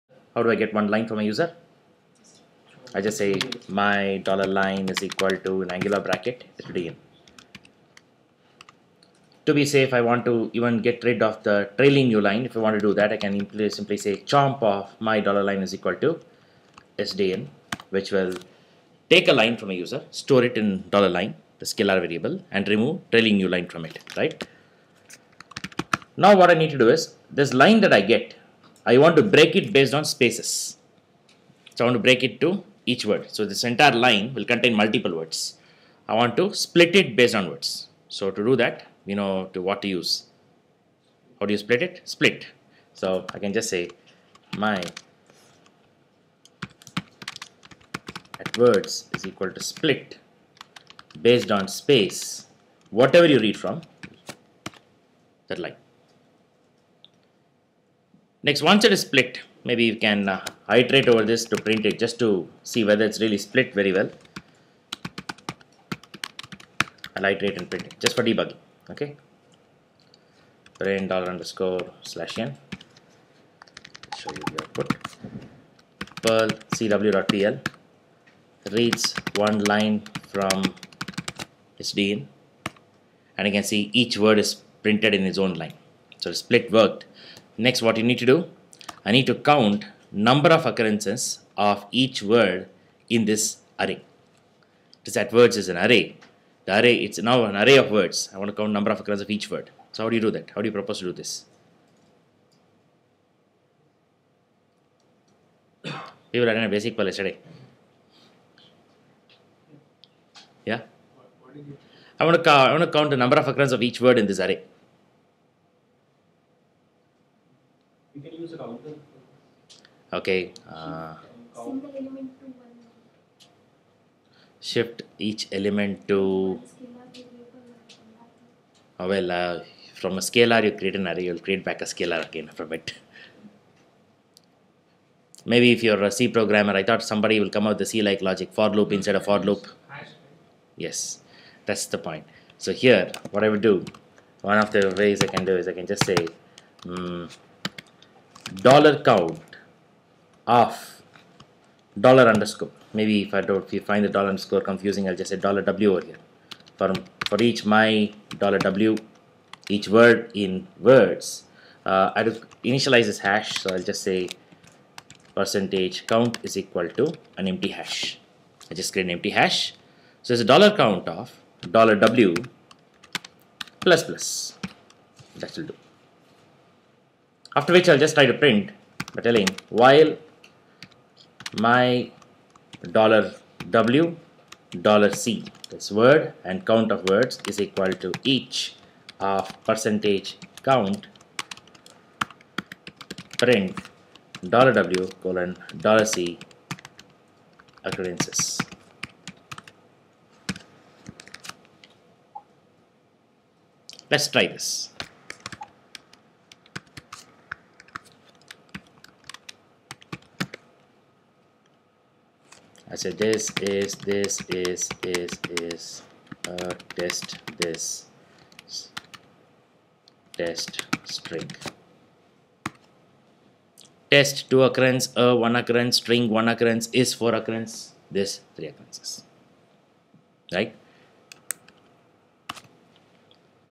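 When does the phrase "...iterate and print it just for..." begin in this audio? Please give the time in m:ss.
1:07.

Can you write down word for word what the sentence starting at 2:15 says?
Maybe if you're a C programmer, I thought somebody will come out with the C-like logic, for loop instead of for loop.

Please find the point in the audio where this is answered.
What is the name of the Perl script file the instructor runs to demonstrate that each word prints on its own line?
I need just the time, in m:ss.
1:16.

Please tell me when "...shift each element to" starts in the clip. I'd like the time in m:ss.
2:04.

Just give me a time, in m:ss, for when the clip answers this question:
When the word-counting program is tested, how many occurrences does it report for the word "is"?
3:47.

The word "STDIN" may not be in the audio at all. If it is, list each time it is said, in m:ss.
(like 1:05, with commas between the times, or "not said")
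0:17, 1:21.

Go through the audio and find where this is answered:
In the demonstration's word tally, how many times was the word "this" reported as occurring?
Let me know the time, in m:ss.
3:48.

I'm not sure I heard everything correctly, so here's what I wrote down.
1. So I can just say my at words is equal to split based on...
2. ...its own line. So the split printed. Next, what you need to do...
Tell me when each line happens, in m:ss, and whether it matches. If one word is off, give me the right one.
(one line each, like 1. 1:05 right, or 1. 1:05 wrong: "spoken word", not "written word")
1. 0:42 right
2. 1:25 wrong: "worked", not "printed".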